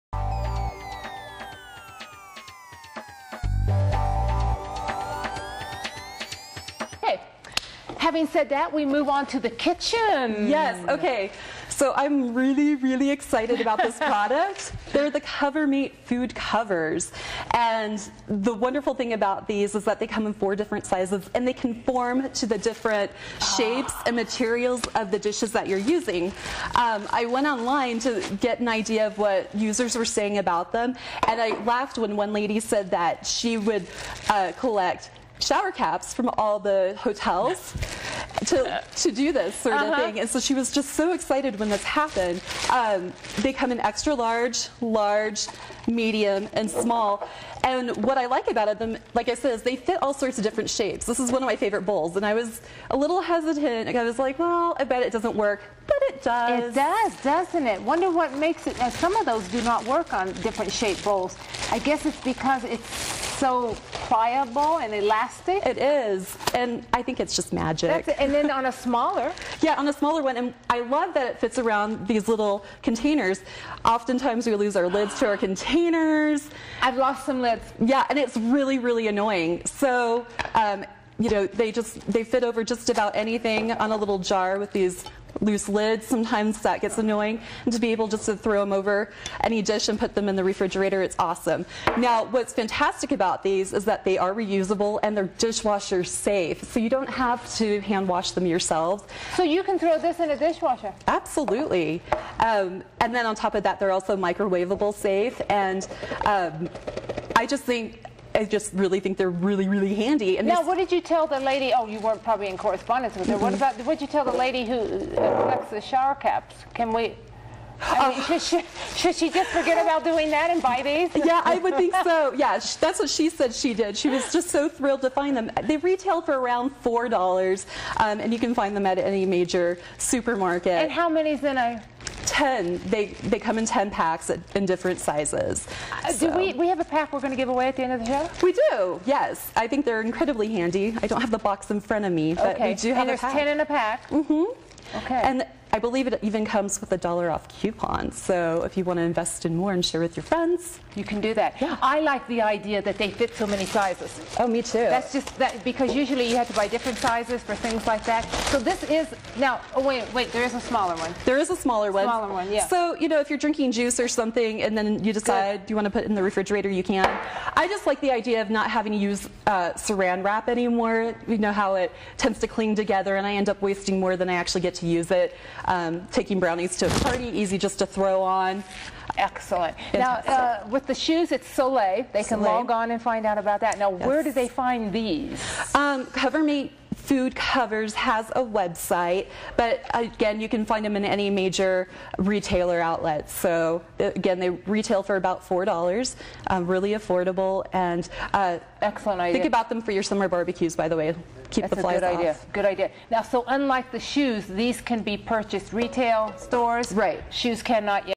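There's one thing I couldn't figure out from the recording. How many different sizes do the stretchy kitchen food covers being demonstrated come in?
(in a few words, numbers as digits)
4.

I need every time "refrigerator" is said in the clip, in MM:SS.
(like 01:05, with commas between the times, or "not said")
01:30, 02:46.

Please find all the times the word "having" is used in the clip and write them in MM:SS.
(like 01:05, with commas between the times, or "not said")
00:08, 02:48.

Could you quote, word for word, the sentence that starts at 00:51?
This is one of my favorite bowls.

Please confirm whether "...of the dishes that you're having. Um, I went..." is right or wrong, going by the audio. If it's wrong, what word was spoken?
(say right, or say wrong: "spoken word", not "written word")
wrong: "using", not "having".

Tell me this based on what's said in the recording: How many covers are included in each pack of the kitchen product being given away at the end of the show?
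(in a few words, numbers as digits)
10.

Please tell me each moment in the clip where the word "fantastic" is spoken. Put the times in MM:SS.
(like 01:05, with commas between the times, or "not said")
01:32, 02:59.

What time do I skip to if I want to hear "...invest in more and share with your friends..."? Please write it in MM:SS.
02:29.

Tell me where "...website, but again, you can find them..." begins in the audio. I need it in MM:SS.
03:08.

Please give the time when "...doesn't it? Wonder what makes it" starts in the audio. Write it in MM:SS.
00:57.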